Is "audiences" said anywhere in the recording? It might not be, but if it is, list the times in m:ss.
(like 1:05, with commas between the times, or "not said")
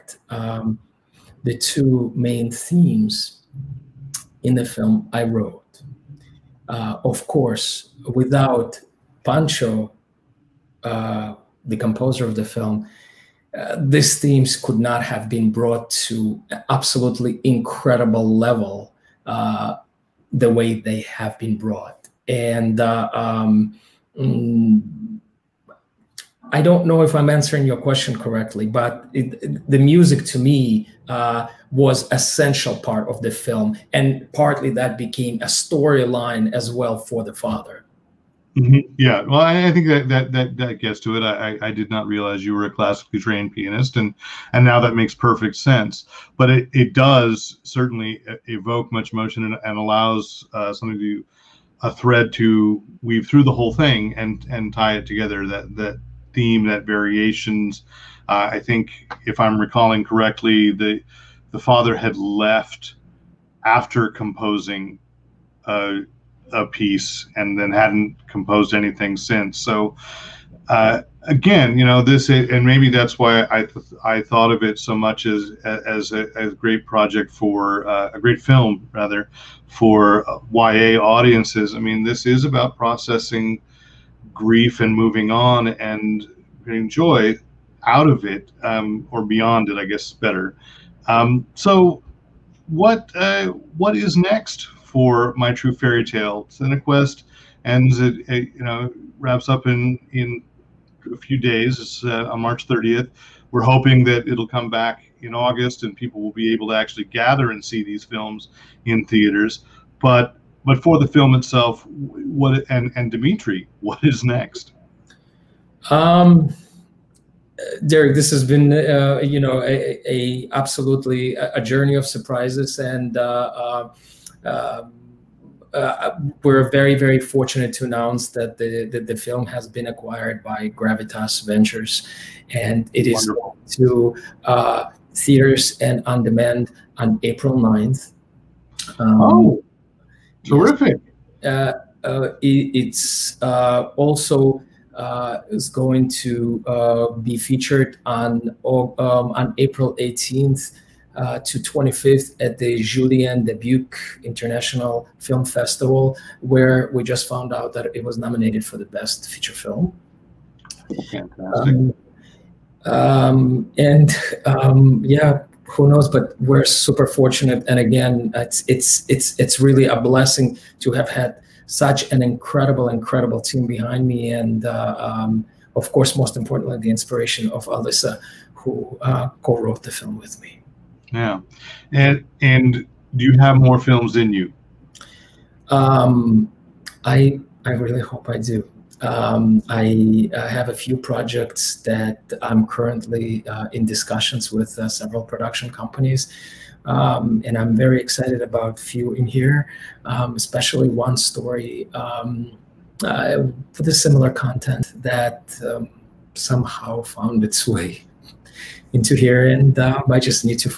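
1:21.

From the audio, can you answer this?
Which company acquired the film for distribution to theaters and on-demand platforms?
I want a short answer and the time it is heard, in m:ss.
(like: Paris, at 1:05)
Gravitas Ventures, at 2:10.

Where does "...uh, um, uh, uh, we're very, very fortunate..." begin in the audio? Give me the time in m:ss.
2:03.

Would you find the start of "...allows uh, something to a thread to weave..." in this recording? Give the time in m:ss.
0:49.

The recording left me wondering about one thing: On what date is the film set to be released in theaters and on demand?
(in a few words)
April 9.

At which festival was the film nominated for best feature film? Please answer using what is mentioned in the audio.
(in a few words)
Julien Dubuque International Film Festival.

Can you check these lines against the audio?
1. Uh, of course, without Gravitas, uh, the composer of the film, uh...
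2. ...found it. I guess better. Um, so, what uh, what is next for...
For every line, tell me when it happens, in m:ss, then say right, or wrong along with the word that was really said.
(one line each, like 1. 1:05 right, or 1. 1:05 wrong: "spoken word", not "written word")
1. 0:06 wrong: "Pancho", not "Gravitas"
2. 1:29 wrong: "beyond", not "found".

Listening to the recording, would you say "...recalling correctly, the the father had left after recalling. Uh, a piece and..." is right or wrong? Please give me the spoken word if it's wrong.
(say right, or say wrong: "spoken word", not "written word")
wrong: "composing", not "recalling".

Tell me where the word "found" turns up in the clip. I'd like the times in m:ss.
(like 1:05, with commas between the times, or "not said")
2:37, 3:27.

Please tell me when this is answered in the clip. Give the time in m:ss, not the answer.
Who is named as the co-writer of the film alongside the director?
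2:57.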